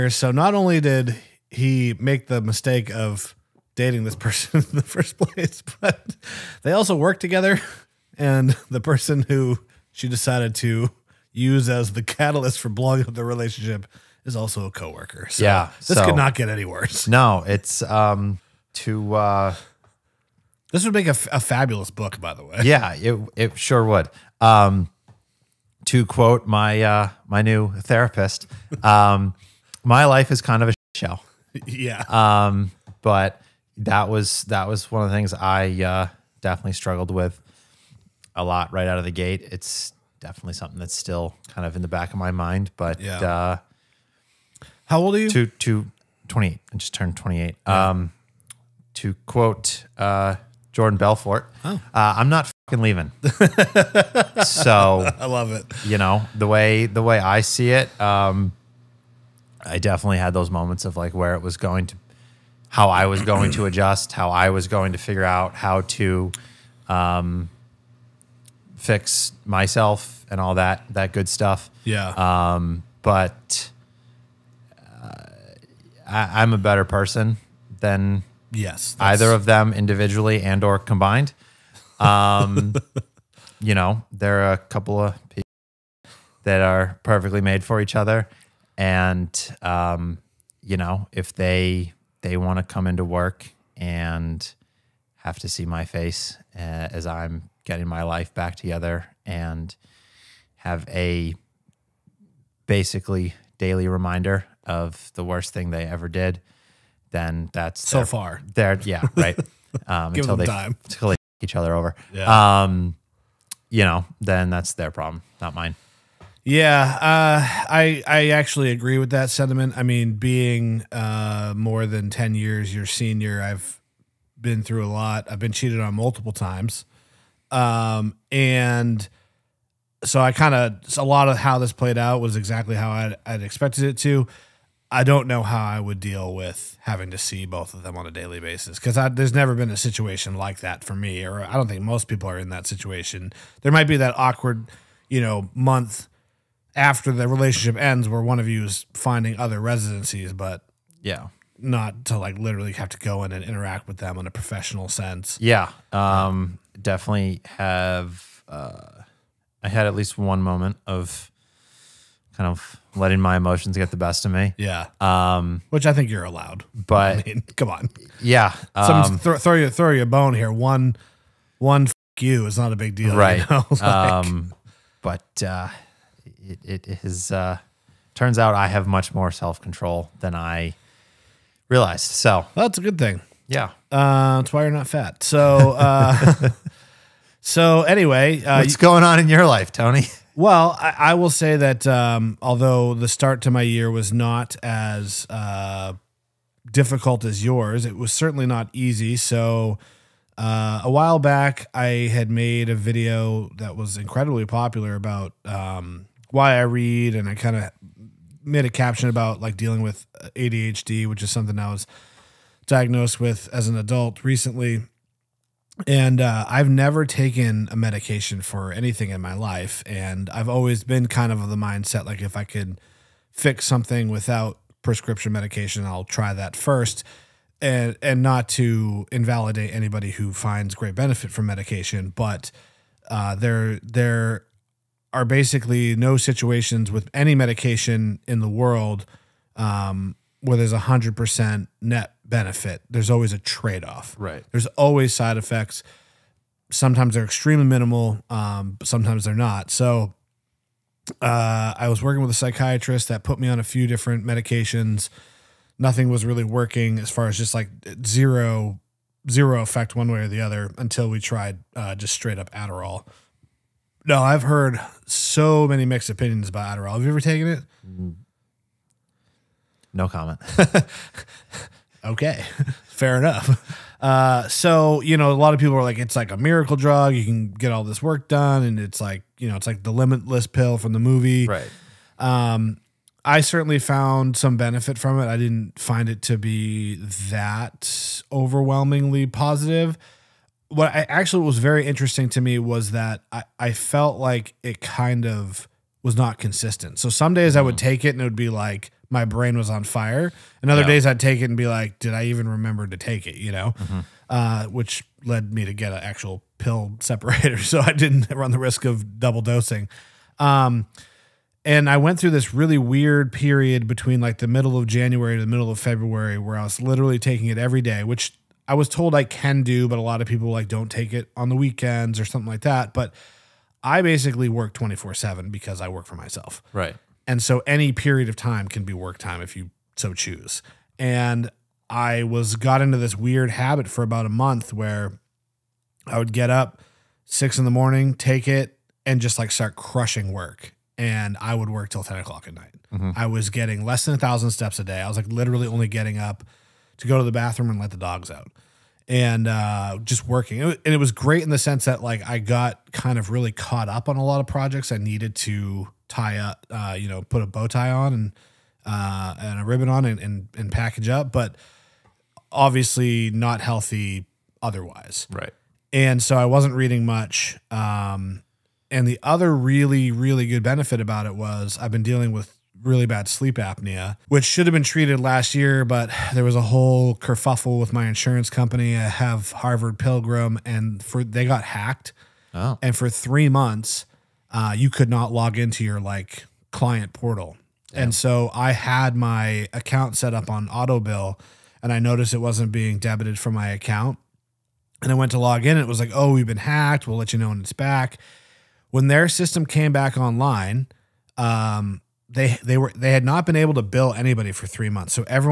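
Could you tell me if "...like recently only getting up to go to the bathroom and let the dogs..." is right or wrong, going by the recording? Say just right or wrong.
wrong.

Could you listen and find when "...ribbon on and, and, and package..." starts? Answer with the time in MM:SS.
05:59.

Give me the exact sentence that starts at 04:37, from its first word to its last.
You can get all this work done, and it's like you know, it's like the limitless pill from the movie.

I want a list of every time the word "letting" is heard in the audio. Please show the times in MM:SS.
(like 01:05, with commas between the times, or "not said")
02:42.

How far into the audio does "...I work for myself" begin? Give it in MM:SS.
05:25.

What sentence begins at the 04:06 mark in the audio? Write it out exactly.
Sometimes they're extremely minimal, um, but sometimes they're not.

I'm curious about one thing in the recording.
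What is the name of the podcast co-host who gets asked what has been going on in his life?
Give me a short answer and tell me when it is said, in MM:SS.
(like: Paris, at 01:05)
Tony, at 03:09.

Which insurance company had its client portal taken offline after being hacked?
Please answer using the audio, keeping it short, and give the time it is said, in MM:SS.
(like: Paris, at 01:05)
Harvard Pilgrim, at 06:19.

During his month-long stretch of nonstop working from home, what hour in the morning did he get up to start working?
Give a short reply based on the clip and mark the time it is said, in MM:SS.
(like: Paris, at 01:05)
6, at 05:37.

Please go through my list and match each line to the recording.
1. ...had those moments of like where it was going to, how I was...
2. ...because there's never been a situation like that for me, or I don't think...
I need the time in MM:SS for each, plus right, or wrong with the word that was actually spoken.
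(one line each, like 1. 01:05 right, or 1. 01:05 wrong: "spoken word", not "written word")
1. 01:00 right
2. 02:18 right.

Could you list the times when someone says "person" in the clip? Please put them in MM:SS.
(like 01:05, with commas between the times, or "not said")
00:04, 00:08, 01:16.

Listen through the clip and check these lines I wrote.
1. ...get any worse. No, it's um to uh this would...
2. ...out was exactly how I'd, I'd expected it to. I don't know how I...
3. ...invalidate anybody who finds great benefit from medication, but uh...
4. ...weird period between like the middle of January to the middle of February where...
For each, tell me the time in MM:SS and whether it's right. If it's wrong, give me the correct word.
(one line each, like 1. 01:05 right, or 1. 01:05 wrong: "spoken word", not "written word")
1. 00:16 right
2. 02:11 right
3. 03:49 right
4. 05:12 right.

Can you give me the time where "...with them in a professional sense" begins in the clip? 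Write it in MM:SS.
02:33.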